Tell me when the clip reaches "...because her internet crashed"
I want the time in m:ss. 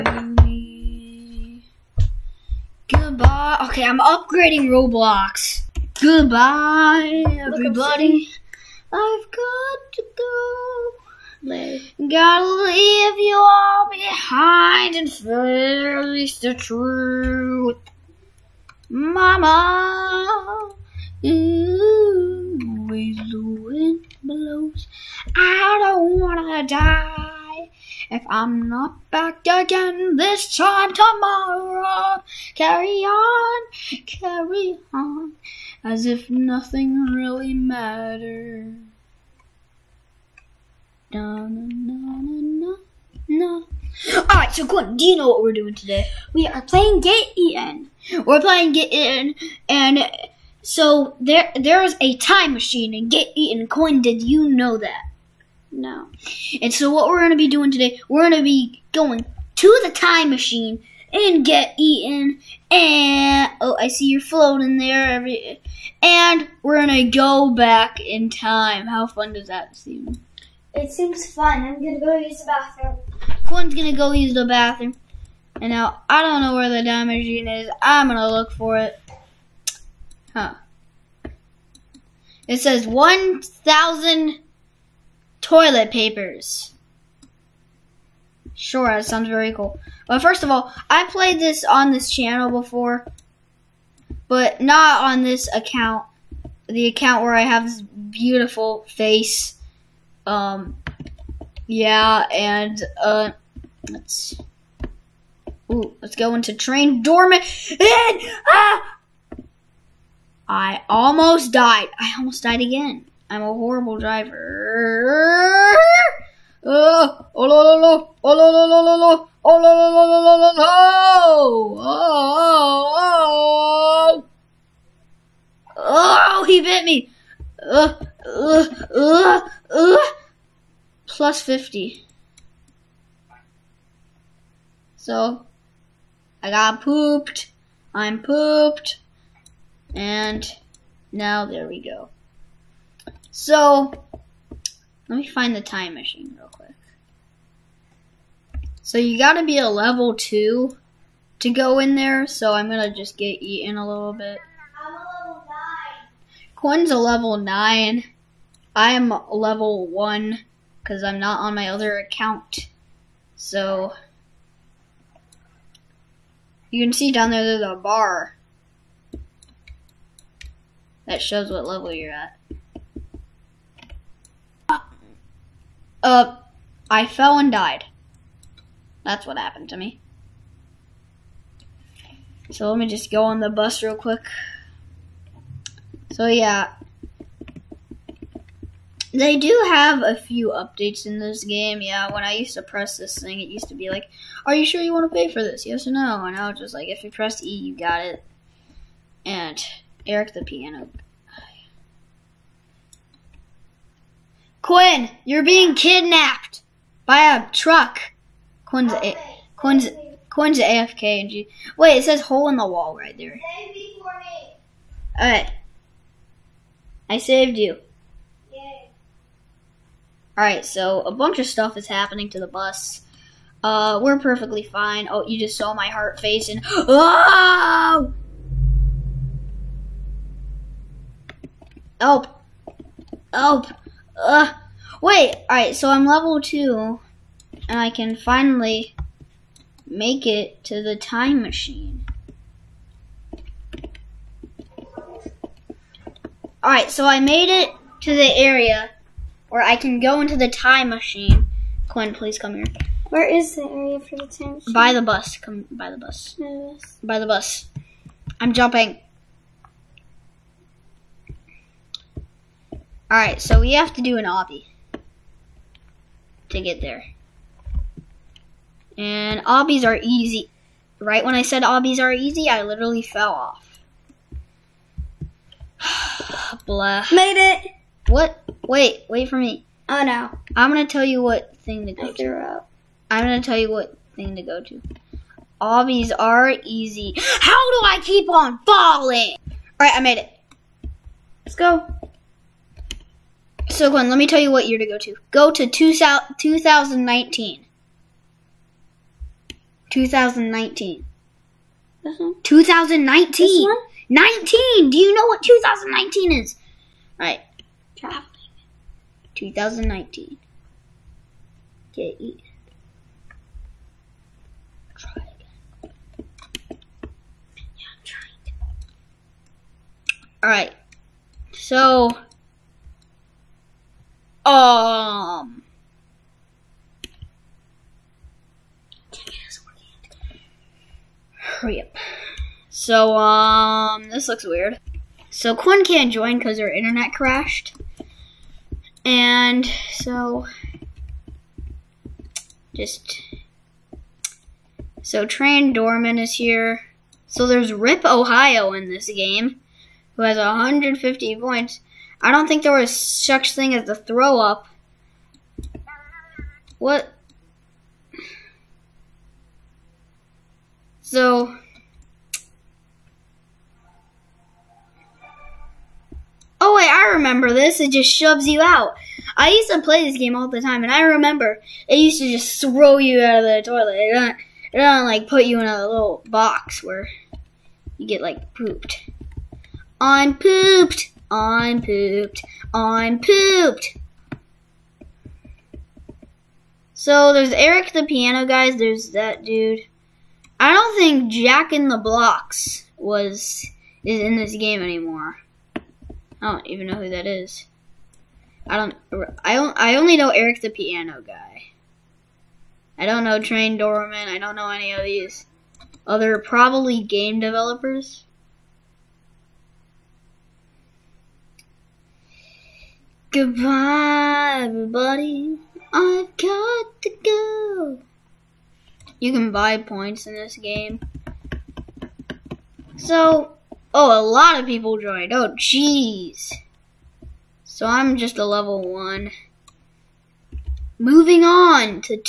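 5:36.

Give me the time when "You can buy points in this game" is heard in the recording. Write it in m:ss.
6:59.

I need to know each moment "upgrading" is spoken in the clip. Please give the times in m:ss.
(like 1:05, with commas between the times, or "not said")
0:04.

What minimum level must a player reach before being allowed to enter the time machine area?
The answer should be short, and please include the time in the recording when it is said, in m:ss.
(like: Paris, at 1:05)
2, at 2:29.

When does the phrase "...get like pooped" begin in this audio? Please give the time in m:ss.
6:18.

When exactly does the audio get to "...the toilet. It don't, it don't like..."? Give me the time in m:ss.
6:13.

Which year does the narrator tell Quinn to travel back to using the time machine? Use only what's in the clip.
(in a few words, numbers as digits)
2019.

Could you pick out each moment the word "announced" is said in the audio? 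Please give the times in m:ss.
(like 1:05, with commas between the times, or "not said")
not said.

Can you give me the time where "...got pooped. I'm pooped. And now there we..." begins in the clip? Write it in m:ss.
2:16.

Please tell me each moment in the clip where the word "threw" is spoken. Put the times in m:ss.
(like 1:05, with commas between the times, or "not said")
4:42.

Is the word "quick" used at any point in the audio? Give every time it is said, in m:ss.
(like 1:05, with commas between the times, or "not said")
2:26, 3:03.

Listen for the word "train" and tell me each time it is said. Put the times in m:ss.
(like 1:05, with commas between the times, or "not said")
1:46, 5:45, 6:43.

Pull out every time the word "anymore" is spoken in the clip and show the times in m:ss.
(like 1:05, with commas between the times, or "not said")
6:34.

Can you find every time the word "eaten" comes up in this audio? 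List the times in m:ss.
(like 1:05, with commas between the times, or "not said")
0:47, 0:53, 1:01, 2:33.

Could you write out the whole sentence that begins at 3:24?
Quinn, you're being kidnapped by a truck.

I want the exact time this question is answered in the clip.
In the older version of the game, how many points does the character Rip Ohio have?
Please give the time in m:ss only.
5:50.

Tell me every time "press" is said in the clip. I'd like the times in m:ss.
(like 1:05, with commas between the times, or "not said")
3:12, 3:17.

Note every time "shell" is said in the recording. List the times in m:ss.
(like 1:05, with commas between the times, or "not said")
not said.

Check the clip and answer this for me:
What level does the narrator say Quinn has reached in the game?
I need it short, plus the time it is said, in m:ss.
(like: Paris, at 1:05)
9, at 2:36.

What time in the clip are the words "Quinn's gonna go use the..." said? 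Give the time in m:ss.
1:13.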